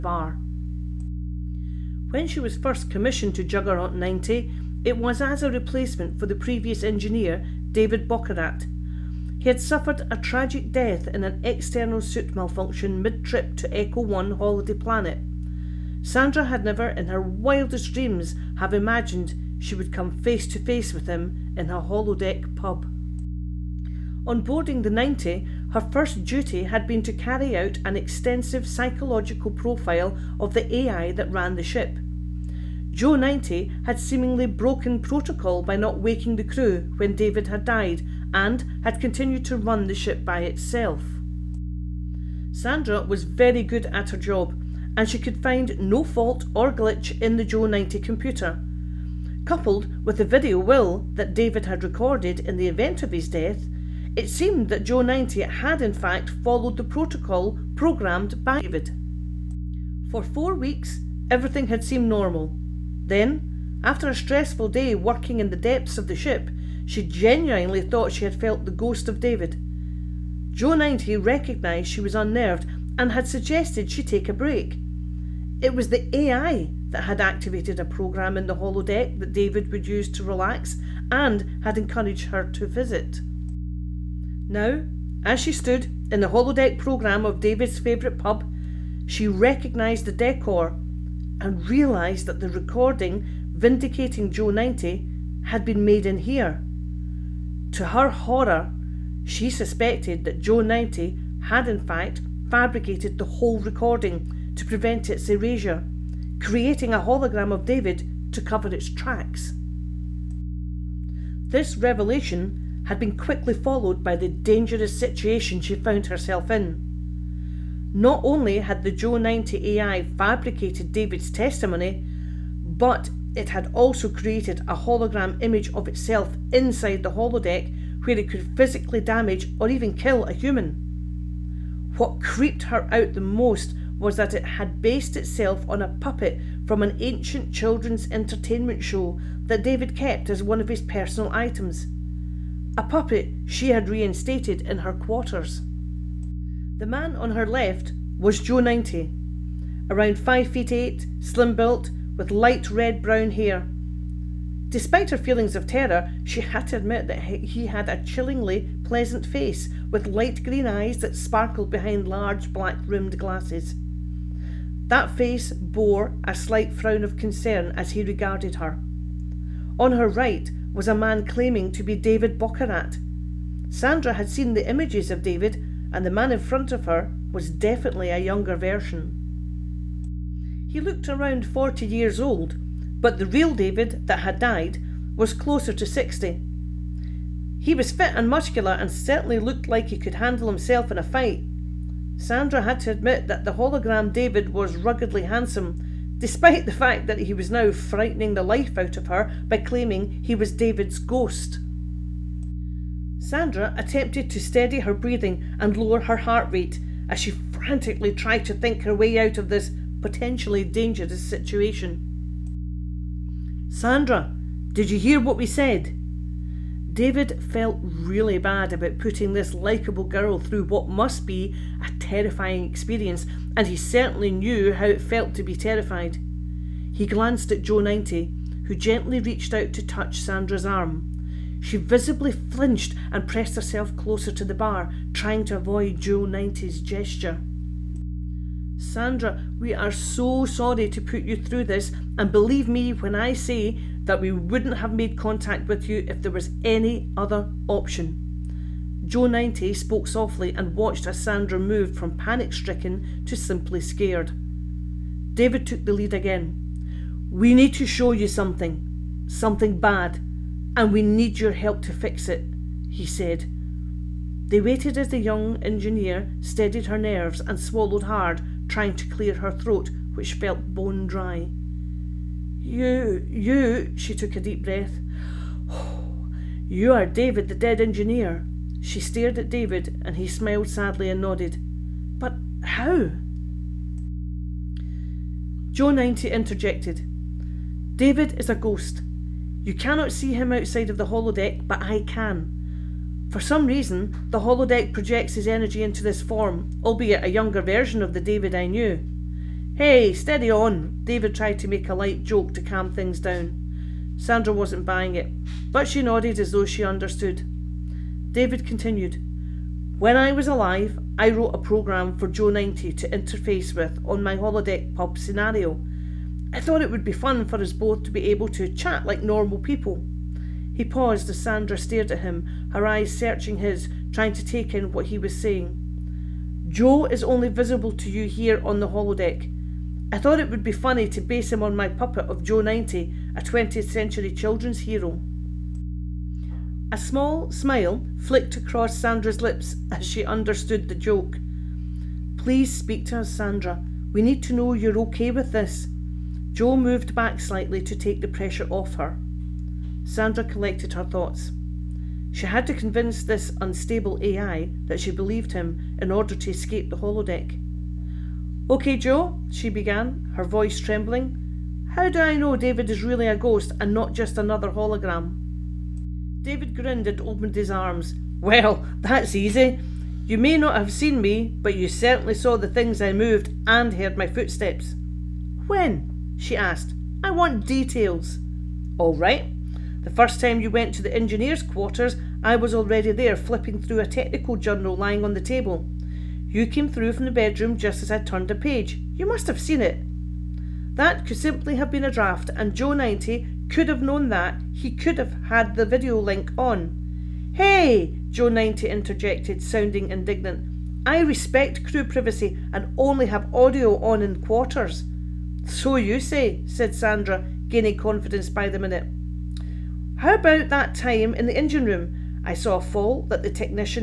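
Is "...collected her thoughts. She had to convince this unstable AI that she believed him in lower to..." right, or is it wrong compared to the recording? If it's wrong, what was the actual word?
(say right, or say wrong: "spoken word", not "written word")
wrong: "order", not "lower".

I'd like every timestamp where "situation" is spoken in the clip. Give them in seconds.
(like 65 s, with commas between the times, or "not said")
114 s, 211 s.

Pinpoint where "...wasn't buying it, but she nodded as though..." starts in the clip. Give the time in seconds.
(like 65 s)
304 s.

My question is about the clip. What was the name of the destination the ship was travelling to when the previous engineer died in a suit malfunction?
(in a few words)
Echo 1 Holiday Planet.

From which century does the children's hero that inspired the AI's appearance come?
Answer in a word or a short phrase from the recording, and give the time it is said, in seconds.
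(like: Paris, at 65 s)
20th century, at 333 s.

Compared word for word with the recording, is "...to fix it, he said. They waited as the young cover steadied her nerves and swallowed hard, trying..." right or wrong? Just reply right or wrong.
wrong.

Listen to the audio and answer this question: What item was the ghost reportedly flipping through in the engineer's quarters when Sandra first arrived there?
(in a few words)
A technical journal.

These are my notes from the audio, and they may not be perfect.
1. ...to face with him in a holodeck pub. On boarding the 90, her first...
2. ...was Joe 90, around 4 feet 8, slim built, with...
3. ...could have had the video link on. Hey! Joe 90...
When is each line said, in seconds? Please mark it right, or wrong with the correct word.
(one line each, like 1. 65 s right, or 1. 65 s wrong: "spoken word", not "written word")
1. 20 s right
2. 148 s wrong: "5", not "4"
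3. 394 s right.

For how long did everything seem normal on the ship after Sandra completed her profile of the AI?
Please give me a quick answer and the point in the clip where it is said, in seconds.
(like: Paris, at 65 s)
Four weeks, at 60 s.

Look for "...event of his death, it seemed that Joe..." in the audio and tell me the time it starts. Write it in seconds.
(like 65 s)
52 s.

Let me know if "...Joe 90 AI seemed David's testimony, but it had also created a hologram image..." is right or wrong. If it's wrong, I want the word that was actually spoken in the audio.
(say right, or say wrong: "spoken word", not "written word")
wrong: "fabricated", not "seemed".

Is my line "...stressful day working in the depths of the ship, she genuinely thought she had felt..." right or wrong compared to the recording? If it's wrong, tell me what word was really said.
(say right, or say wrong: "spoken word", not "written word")
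right.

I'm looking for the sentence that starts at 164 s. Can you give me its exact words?
That face bore a slight frown of concern as he regarded her.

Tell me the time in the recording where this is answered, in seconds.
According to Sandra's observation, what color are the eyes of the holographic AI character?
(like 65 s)
160 s.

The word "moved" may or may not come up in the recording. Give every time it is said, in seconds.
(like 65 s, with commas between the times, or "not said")
251 s, 346 s, 373 s.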